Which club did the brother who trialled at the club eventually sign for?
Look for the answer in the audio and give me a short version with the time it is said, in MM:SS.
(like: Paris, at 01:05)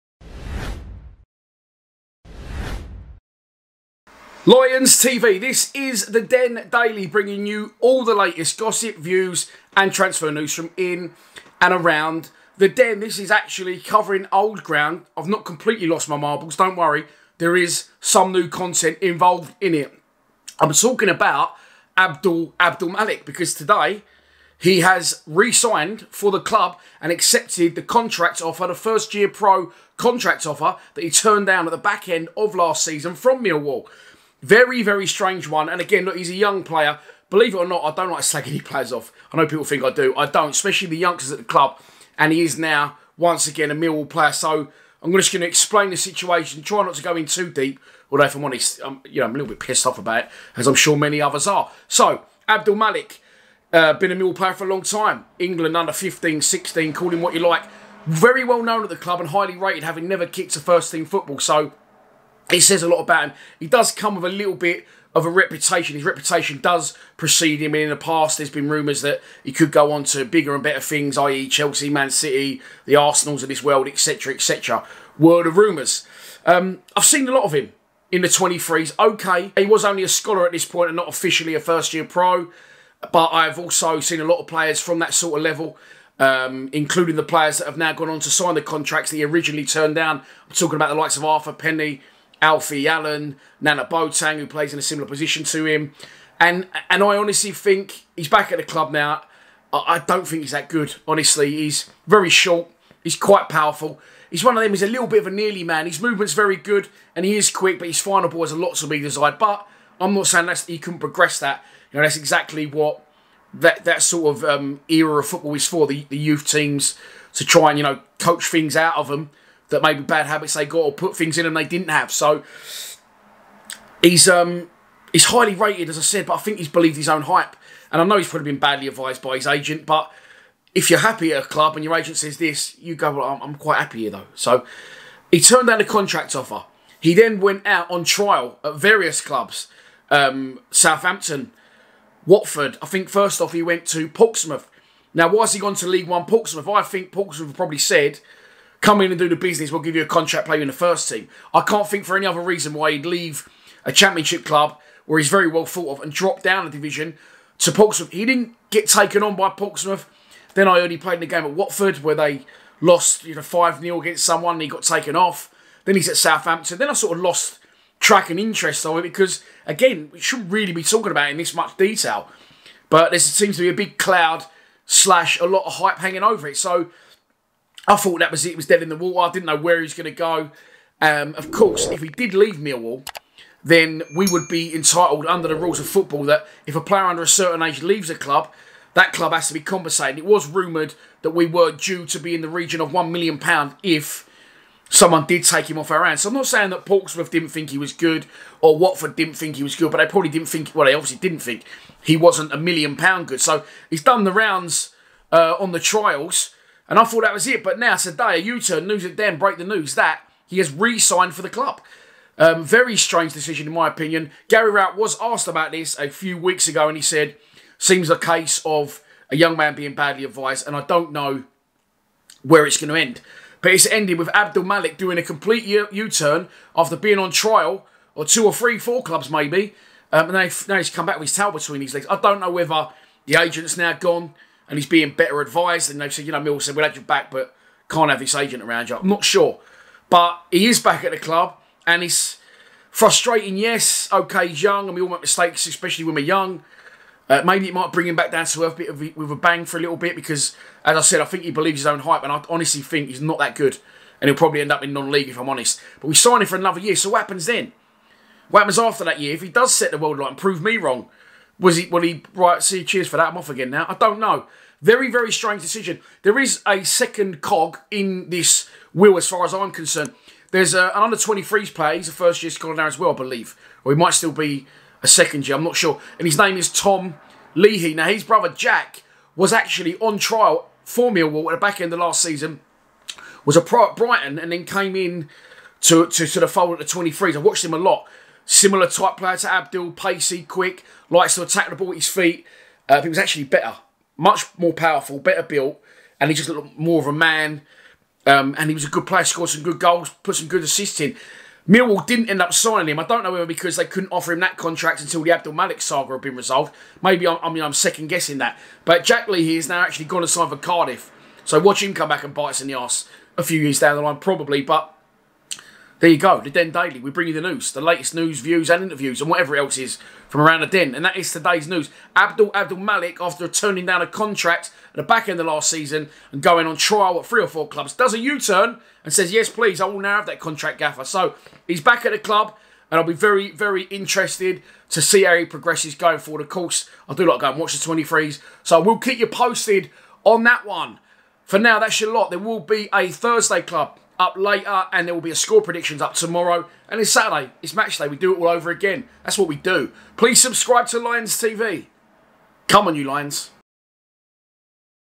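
Cardiff, at 05:10.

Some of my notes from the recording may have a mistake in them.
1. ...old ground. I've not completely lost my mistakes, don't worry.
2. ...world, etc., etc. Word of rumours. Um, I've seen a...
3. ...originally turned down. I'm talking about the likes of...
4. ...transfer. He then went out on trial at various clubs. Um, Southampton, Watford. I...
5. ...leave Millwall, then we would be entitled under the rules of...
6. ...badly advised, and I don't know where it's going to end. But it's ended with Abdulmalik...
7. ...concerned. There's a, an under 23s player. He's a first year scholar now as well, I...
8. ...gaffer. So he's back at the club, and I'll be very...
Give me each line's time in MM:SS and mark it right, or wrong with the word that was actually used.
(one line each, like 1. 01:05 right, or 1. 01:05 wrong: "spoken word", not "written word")
1. 00:14 wrong: "marbles", not "mistakes"
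2. 01:13 right
3. 01:29 right
4. 02:16 wrong: "offer", not "transfer"
5. 03:02 right
6. 03:39 right
7. 04:29 right
8. 05:30 right.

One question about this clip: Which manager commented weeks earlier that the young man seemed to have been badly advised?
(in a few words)
Gary Rowett.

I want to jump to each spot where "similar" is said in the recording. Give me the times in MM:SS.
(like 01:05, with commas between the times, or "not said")
01:34, 04:48.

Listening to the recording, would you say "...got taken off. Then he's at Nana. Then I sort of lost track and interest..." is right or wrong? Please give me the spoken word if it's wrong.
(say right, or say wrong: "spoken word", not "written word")
wrong: "Southampton", not "Nana".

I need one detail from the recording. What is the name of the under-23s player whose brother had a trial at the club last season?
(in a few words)
Tom Leahy.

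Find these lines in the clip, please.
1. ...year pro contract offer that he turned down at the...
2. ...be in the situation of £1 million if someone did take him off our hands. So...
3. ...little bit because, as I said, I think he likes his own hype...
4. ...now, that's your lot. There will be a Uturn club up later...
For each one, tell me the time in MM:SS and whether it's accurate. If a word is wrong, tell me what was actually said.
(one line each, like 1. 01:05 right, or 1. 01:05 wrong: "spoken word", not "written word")
1. 00:29 right
2. 03:12 wrong: "region", not "situation"
3. 04:09 wrong: "believes", not "likes"
4. 05:41 wrong: "Thursday", not "Uturn".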